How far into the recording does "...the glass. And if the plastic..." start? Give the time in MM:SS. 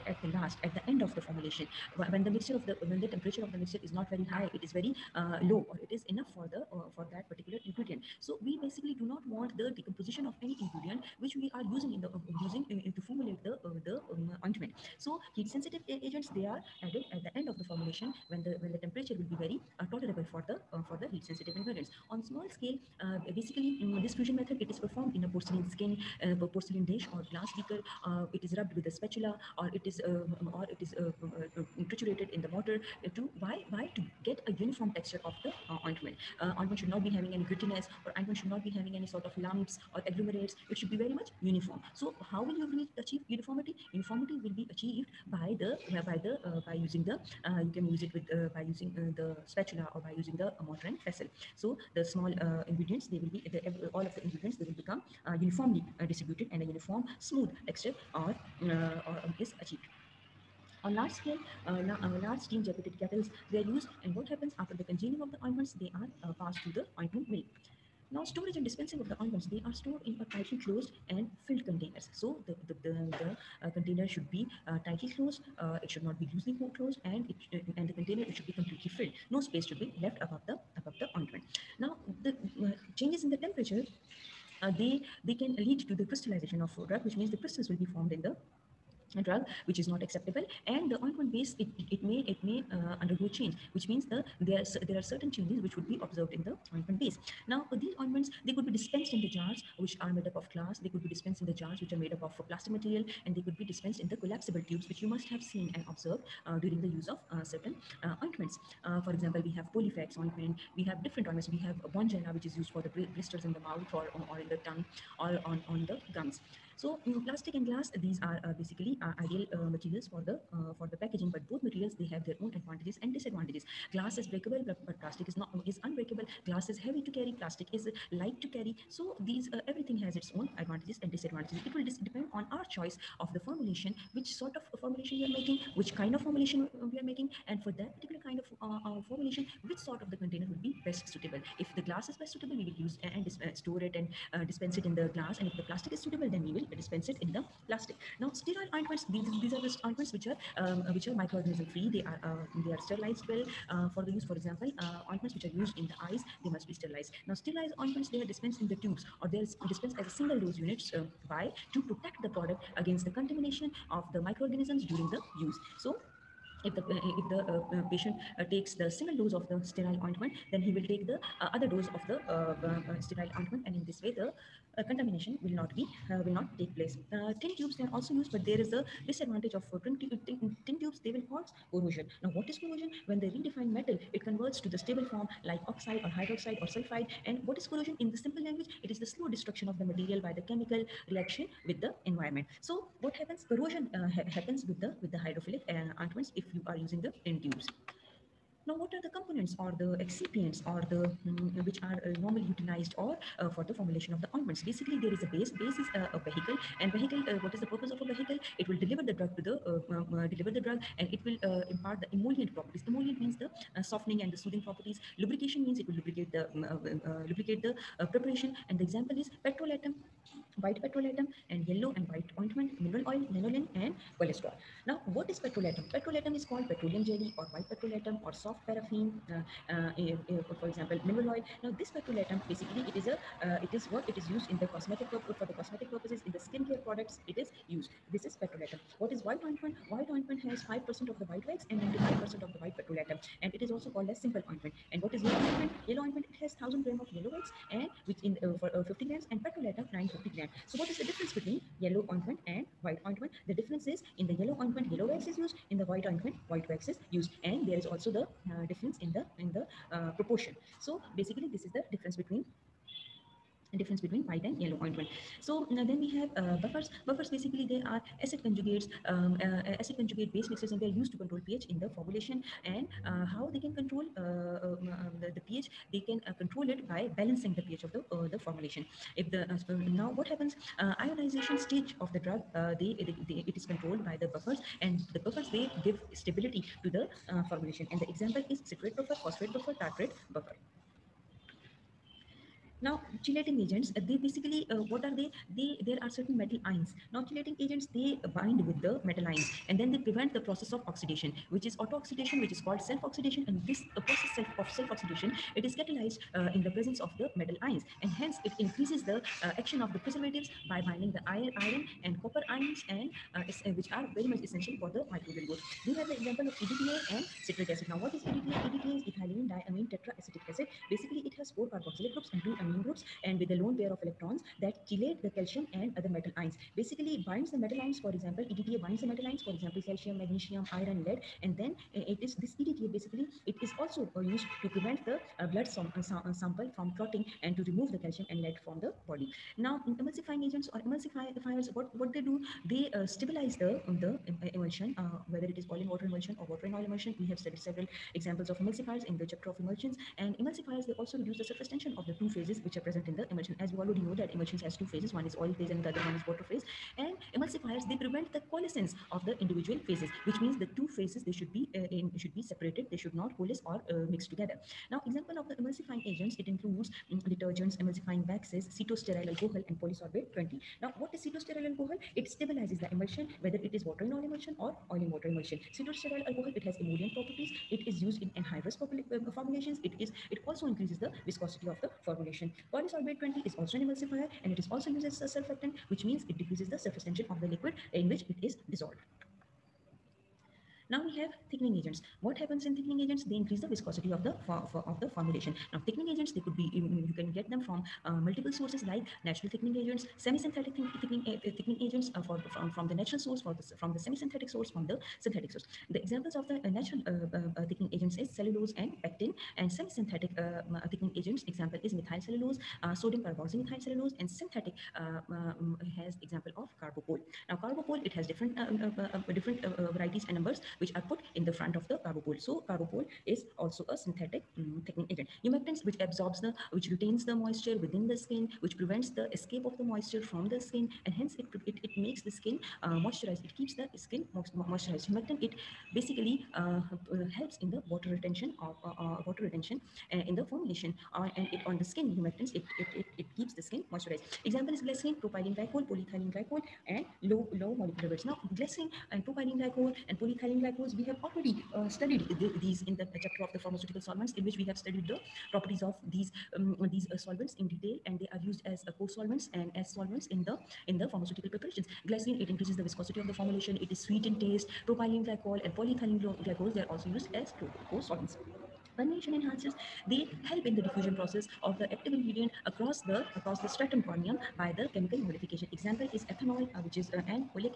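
02:24.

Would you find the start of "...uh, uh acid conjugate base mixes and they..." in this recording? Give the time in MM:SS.
04:29.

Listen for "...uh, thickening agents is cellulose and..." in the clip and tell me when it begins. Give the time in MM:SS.
06:47.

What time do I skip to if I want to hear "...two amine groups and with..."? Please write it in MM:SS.
05:22.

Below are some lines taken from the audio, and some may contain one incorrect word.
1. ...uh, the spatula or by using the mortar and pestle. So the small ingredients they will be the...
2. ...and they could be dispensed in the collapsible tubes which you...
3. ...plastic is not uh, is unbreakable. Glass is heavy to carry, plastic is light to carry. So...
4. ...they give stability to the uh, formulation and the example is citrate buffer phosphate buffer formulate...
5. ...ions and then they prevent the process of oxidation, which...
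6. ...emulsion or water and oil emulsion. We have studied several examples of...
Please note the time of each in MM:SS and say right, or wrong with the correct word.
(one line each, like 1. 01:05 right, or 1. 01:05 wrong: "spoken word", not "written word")
1. 00:48 right
2. 01:43 right
3. 02:04 right
4. 04:45 wrong: "tartrate", not "formulate"
5. 04:59 right
6. 05:46 right.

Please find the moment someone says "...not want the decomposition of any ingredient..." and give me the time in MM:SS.
00:09.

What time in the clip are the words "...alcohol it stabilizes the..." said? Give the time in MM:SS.
06:11.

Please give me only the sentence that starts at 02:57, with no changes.
Uh, tin tubes they are also used, but there is a disadvantage of uh, tin, tin, tin tubes.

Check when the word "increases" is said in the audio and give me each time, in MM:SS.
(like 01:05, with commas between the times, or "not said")
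05:08, 06:20, 06:33, 07:42.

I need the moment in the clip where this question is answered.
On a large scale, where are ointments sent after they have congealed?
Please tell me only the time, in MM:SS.
01:06.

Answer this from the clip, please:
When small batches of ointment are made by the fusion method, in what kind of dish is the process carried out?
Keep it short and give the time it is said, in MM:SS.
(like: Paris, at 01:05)
Porcelain dish, at 00:26.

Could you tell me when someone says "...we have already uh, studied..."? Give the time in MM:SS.
07:30.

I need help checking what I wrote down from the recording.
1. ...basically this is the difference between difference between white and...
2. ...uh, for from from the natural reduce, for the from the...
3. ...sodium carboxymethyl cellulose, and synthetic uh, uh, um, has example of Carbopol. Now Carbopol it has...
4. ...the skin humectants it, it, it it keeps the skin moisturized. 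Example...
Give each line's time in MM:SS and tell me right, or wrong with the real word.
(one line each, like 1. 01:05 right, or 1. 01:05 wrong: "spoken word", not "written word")
1. 04:21 right
2. 06:42 wrong: "source", not "reduce"
3. 06:52 right
4. 07:21 right.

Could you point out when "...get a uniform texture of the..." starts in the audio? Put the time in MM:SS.
00:34.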